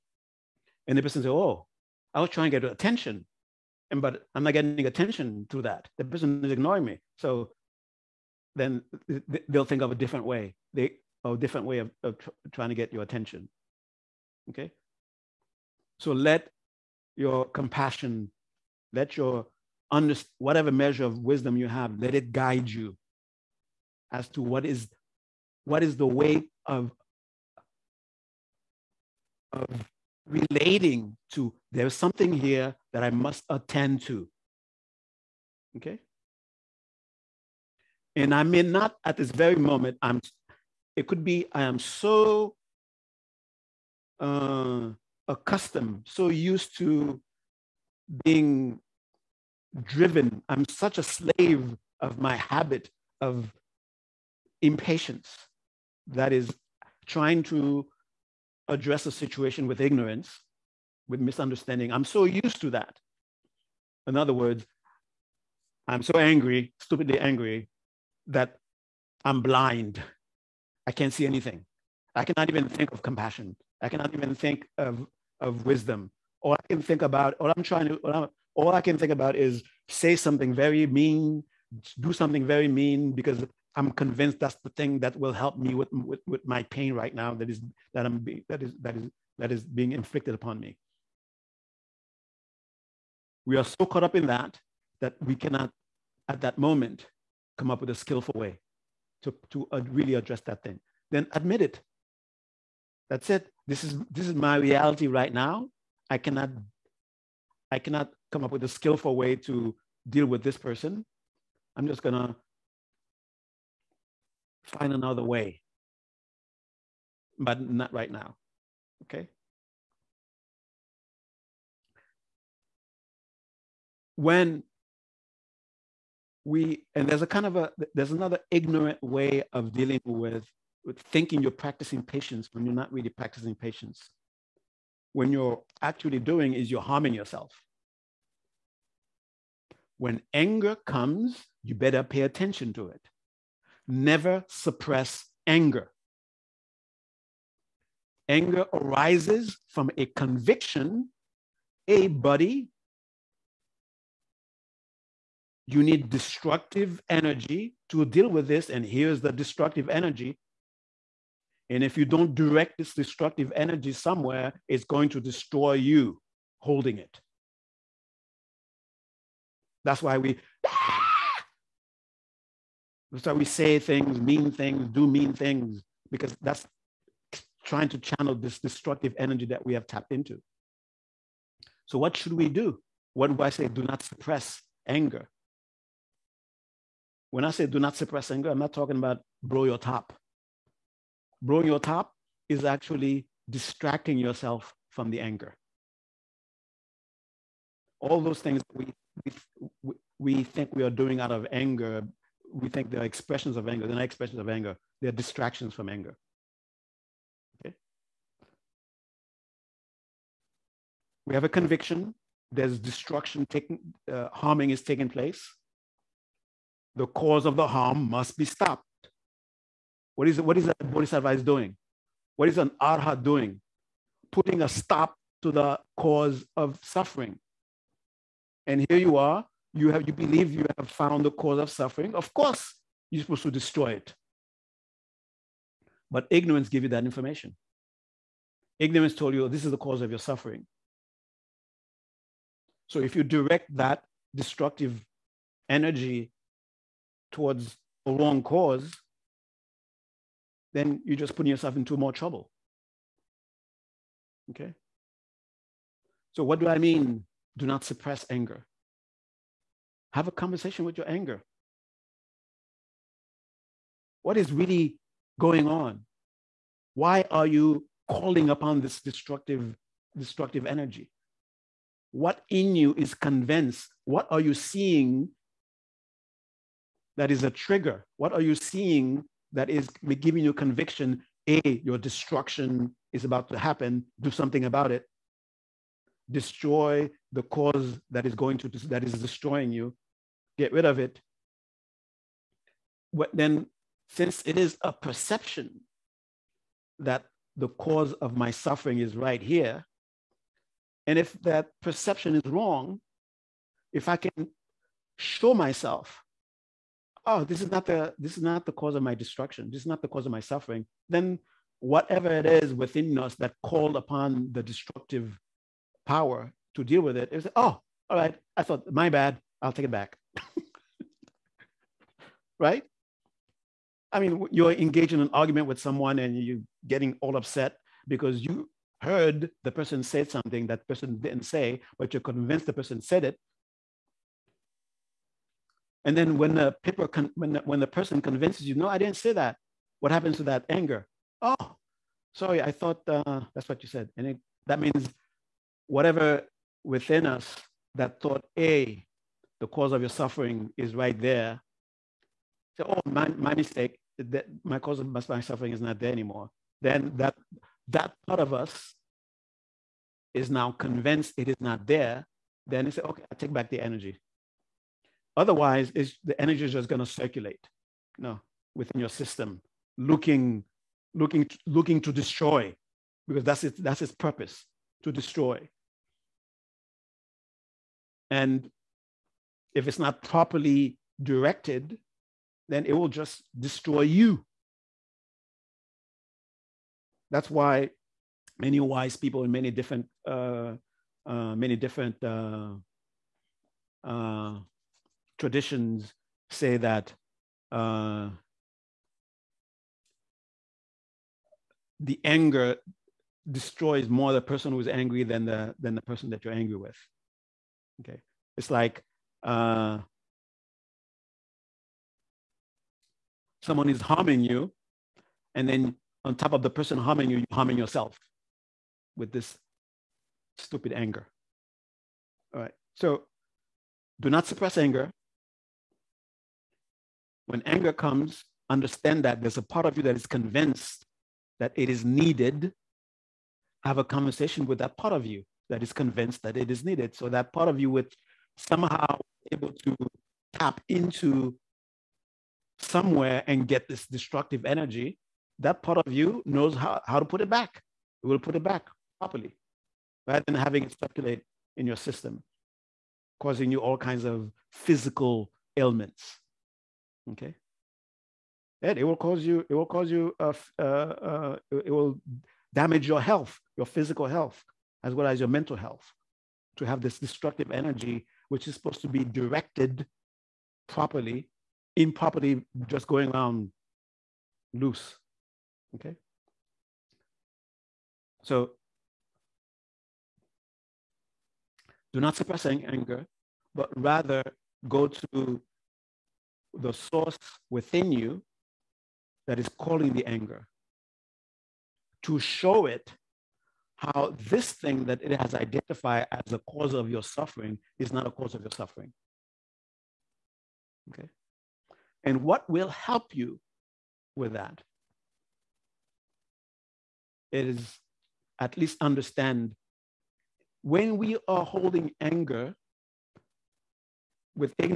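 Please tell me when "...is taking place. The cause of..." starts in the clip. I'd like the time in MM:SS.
03:34.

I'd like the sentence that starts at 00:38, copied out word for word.
And I may not at this very moment, I'm it could be I am so uh, accustomed, so used to being driven.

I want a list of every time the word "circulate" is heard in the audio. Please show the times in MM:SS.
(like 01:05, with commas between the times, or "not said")
06:07, 07:30.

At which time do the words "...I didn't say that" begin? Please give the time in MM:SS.
05:38.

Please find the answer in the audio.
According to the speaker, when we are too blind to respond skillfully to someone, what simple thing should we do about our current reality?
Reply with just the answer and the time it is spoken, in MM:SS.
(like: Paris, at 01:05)
Admit it, at 01:41.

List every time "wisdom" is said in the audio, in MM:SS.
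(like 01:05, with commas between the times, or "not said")
00:21, 01:15.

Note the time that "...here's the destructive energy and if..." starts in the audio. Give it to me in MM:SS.
02:38.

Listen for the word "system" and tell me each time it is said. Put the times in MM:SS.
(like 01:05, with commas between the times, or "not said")
06:09, 07:31.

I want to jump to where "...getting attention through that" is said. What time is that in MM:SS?
00:04.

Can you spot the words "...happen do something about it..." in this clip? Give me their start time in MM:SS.
04:43.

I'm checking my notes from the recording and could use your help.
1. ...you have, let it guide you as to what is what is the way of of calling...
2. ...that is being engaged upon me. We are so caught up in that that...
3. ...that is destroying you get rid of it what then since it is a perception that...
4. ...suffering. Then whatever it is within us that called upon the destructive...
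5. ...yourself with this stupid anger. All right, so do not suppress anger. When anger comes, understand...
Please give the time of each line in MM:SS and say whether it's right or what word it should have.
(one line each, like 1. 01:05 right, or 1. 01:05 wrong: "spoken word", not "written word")
1. 00:21 wrong: "relating", not "calling"
2. 01:29 wrong: "inflicted", not "engaged"
3. 04:48 right
4. 05:10 right
5. 06:57 right.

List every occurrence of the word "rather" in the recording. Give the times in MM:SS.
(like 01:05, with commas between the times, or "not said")
07:30, 08:03.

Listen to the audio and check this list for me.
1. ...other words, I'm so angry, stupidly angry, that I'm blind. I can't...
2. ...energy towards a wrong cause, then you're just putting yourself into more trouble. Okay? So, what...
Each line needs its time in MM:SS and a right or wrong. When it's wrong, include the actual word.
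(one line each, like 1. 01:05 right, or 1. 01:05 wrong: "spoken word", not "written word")
1. 01:04 right
2. 04:05 right.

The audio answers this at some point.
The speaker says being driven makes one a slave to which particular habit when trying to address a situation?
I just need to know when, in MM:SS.
00:54.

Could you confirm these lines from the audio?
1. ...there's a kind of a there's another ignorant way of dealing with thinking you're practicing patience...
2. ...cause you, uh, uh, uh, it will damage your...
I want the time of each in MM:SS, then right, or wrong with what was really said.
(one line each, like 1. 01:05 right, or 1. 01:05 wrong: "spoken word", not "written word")
1. 02:07 right
2. 07:39 right.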